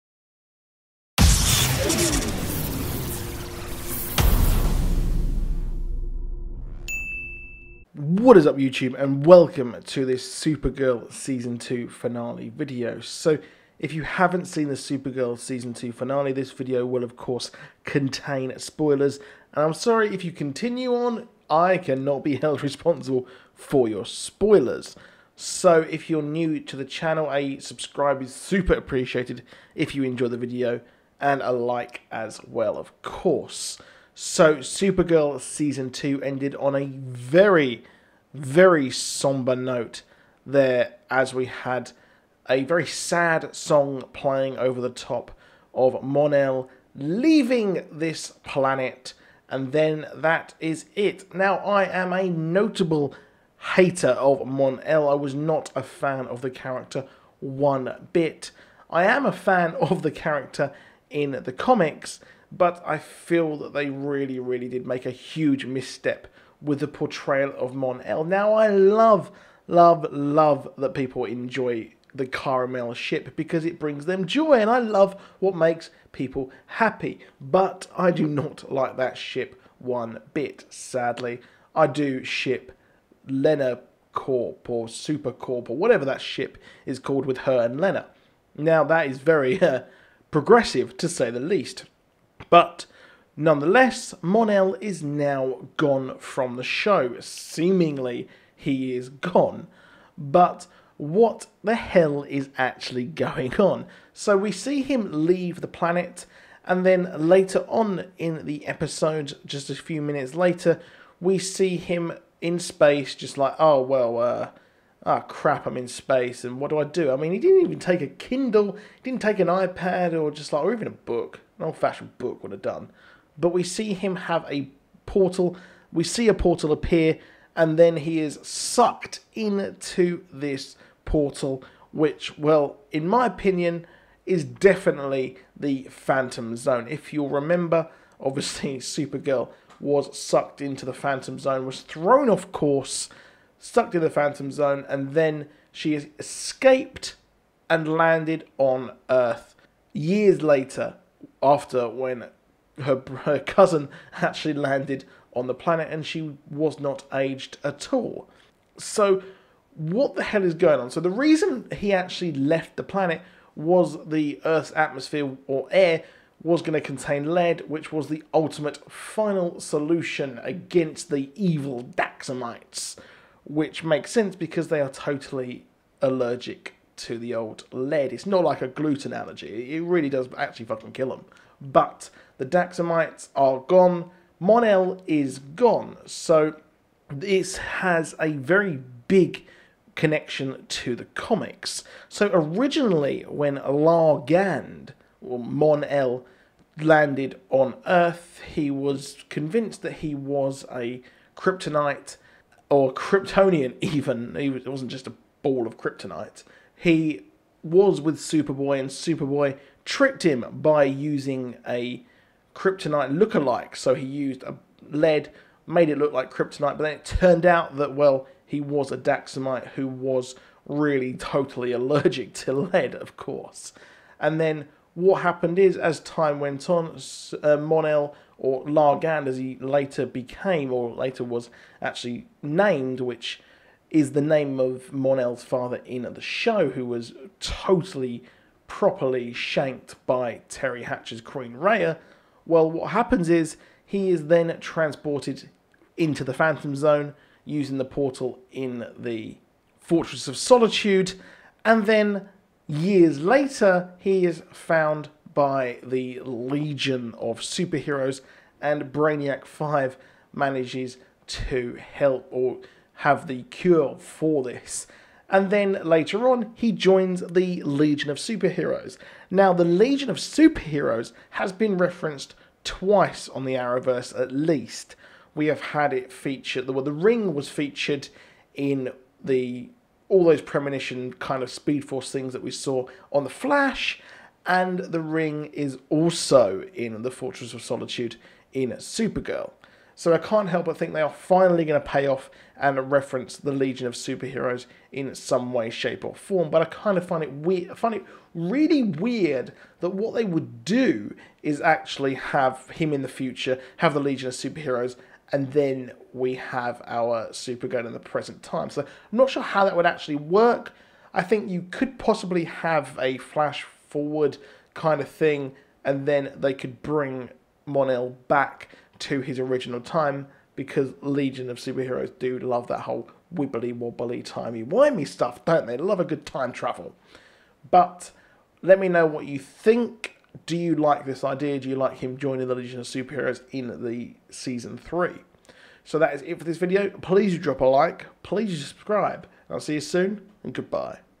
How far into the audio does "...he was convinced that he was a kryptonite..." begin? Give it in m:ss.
3:18.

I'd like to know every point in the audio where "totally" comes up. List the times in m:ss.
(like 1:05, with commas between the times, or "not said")
2:54, 3:41, 3:57.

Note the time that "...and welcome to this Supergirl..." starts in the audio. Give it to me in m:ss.
0:09.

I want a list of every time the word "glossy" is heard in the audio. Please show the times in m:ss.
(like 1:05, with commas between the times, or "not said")
not said.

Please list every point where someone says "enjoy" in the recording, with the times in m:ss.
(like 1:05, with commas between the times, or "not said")
0:30, 1:11.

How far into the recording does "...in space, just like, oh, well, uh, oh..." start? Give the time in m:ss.
1:52.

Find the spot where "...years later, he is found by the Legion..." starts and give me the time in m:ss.
4:12.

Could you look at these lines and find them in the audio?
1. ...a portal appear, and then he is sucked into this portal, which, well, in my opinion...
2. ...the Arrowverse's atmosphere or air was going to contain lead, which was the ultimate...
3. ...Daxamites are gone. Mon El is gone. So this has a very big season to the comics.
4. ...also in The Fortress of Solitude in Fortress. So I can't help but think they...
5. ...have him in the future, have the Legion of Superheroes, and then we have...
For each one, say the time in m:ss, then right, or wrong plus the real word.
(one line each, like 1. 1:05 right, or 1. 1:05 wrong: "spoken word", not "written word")
1. 2:06 right
2. 2:44 wrong: "Earth", not "Arrowverse"
3. 3:02 wrong: "connection", not "season"
4. 4:45 wrong: "Supergirl", not "Fortress"
5. 5:02 right.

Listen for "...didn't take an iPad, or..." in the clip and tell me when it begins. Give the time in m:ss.
1:59.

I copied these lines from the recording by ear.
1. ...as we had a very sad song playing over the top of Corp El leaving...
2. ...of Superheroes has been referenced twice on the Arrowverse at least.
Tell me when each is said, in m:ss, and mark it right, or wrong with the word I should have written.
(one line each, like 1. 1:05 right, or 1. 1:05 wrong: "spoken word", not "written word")
1. 0:41 wrong: "Mon", not "Corp"
2. 4:30 right.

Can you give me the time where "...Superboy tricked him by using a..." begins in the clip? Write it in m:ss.
3:28.